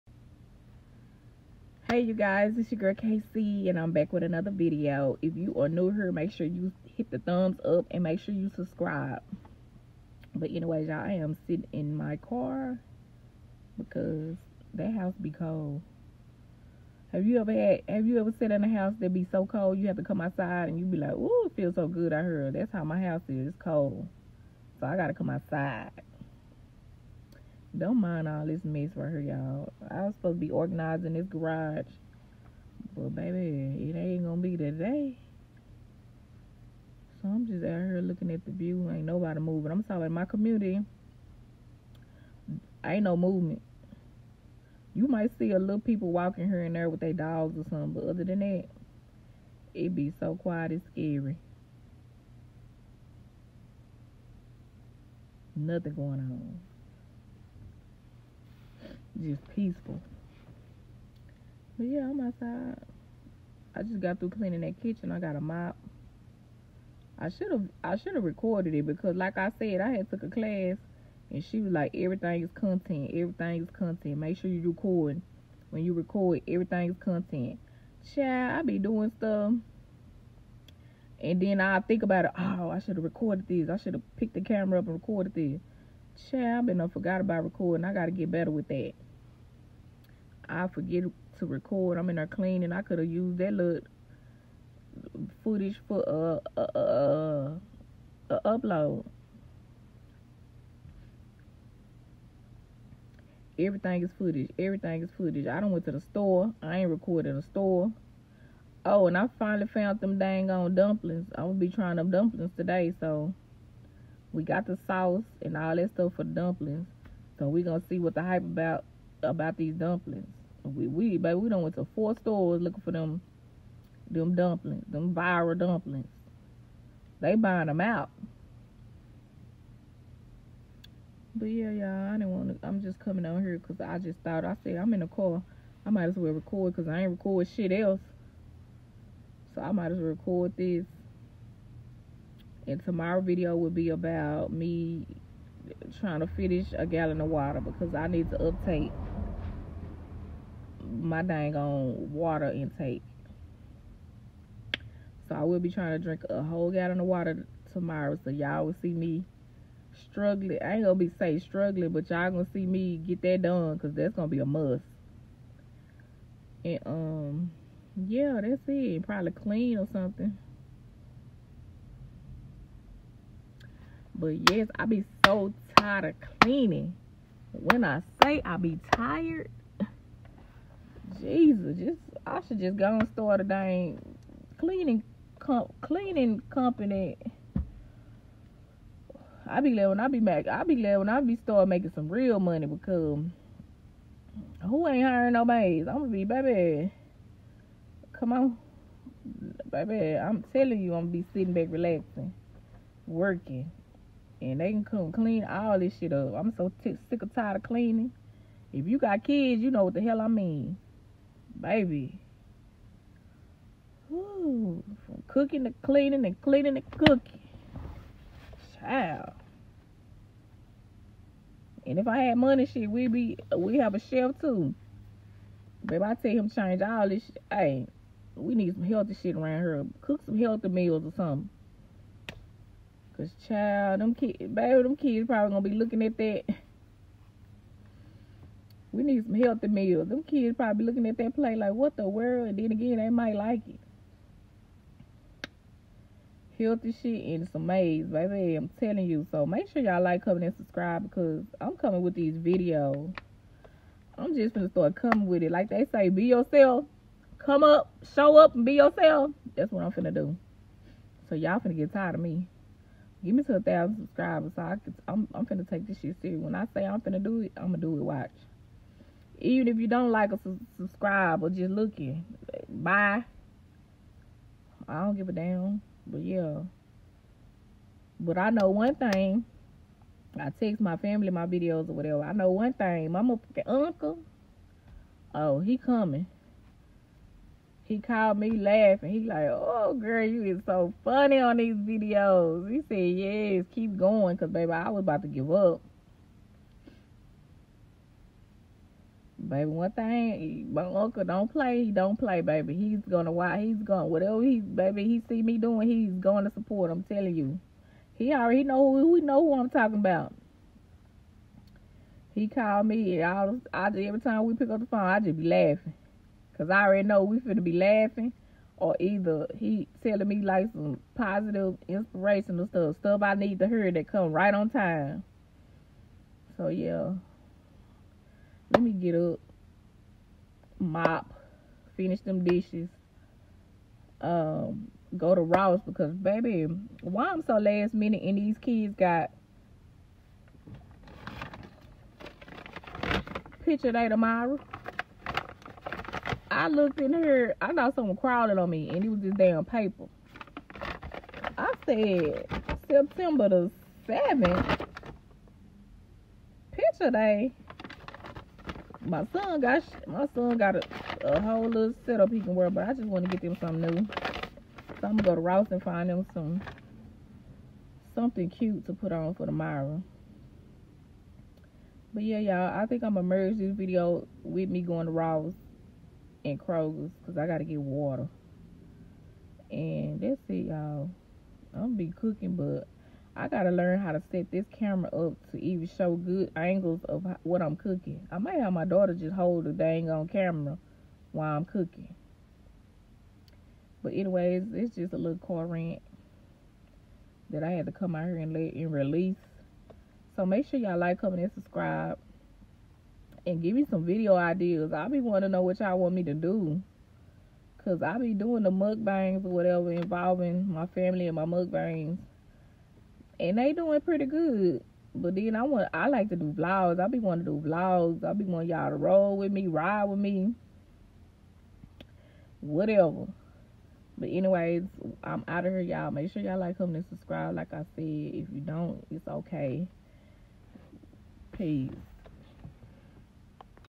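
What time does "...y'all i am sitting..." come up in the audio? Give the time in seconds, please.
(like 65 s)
10 s.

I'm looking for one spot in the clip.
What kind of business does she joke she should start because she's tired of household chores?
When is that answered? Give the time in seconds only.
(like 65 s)
185 s.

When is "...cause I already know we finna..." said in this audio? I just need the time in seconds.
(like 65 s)
316 s.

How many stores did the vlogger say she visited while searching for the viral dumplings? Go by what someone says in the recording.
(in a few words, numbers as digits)
4.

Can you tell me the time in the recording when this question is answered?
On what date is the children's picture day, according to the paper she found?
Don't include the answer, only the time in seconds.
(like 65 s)
352 s.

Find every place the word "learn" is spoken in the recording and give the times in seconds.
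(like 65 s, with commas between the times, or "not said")
383 s.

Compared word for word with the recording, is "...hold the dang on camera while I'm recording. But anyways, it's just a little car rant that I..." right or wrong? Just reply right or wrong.
wrong.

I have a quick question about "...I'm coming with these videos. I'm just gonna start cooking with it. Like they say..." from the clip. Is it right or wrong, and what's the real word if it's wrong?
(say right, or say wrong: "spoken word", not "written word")
wrong: "coming", not "cooking".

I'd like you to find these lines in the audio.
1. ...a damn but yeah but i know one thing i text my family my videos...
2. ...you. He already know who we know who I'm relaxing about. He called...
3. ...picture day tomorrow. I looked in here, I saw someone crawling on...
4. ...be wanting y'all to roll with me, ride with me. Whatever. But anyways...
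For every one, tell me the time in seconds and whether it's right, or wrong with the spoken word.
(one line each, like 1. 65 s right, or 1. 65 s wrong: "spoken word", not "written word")
1. 275 s right
2. 307 s wrong: "talking", not "relaxing"
3. 343 s right
4. 418 s right.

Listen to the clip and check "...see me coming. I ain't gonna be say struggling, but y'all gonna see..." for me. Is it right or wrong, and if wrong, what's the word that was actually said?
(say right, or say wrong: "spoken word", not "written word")
wrong: "struggling", not "coming".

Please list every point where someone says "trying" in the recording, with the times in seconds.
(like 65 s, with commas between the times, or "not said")
111 s, 145 s, 155 s.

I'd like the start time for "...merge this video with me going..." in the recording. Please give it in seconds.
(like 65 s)
373 s.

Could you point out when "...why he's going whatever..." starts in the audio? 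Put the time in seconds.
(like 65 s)
303 s.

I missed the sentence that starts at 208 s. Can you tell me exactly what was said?
If you got kids, you know what the hell I mean baby.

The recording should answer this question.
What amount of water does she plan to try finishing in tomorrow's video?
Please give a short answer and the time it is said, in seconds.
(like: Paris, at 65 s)
A gallon, at 146 s.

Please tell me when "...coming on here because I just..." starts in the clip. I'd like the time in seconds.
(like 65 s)
132 s.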